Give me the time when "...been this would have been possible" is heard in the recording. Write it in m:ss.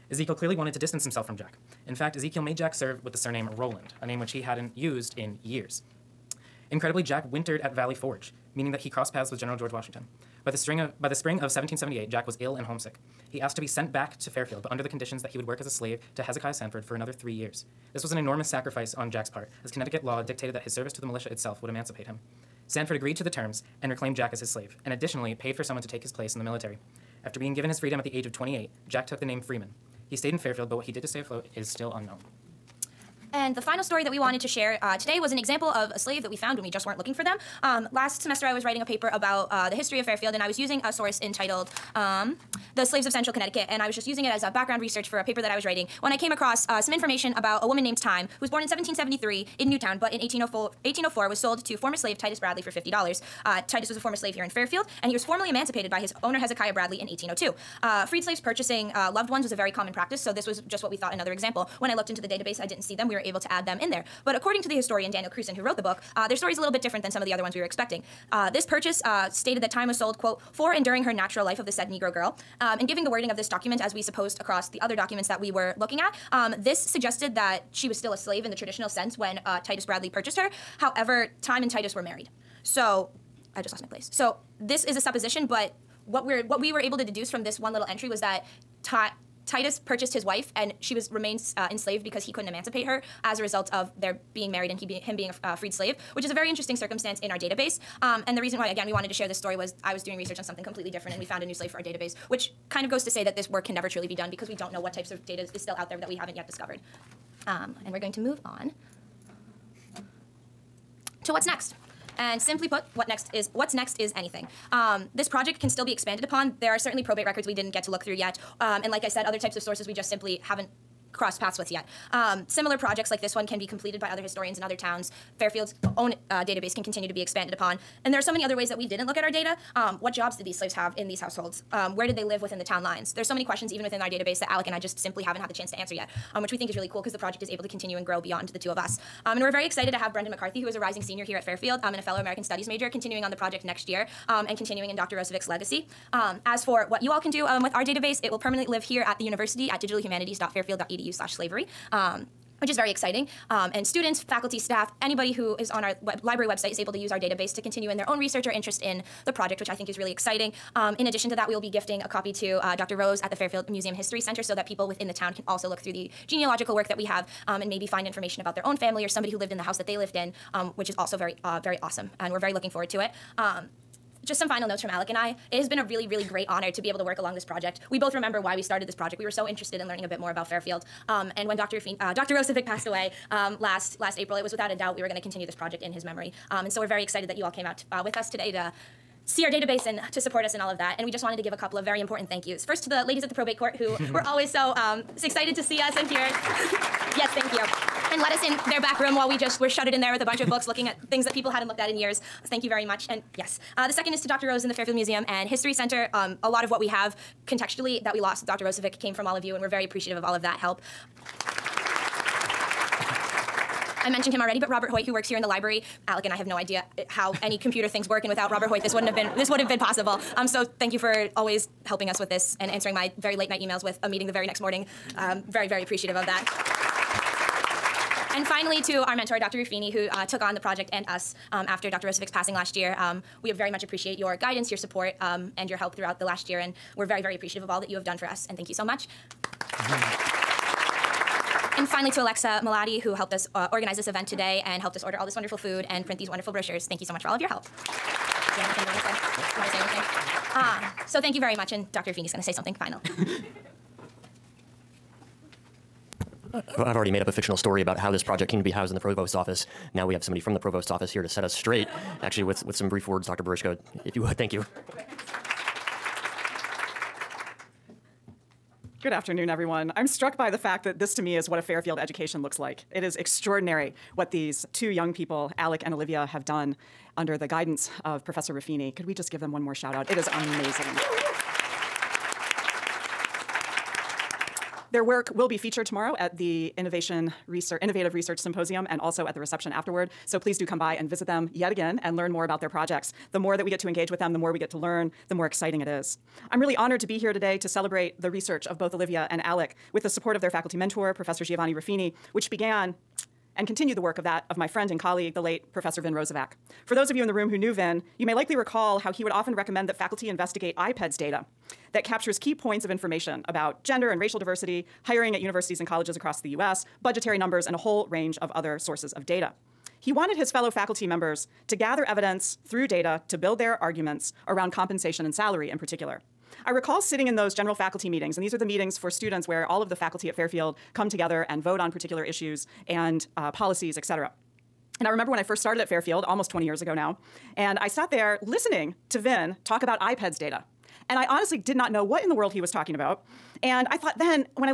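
3:39.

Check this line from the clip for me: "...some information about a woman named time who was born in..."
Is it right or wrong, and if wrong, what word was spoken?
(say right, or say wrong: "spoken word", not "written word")
right.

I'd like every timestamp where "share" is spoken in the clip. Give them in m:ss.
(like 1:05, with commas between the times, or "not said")
0:34, 1:39.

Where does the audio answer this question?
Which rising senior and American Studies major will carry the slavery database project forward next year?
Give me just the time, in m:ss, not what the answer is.
2:20.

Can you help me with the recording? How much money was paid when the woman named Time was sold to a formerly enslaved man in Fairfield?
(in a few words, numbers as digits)
$50.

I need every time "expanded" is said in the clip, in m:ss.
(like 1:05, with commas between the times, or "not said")
1:55, 2:07.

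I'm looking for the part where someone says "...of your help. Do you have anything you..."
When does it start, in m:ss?
4:07.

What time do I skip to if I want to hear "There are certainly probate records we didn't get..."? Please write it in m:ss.
1:56.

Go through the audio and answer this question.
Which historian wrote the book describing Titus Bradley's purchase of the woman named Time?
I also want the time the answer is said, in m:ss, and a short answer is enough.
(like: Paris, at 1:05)
Daniel Cruson, at 1:05.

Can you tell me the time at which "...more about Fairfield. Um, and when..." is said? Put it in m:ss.
3:00.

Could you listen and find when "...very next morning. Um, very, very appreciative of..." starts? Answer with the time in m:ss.
3:44.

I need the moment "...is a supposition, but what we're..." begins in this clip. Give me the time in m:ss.
1:24.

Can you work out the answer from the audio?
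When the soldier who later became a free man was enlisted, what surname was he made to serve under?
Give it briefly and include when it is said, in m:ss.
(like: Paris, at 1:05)
Roland, at 0:03.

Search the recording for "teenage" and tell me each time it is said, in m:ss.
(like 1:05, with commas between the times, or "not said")
not said.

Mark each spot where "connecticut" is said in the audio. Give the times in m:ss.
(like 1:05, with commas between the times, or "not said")
0:19, 0:43.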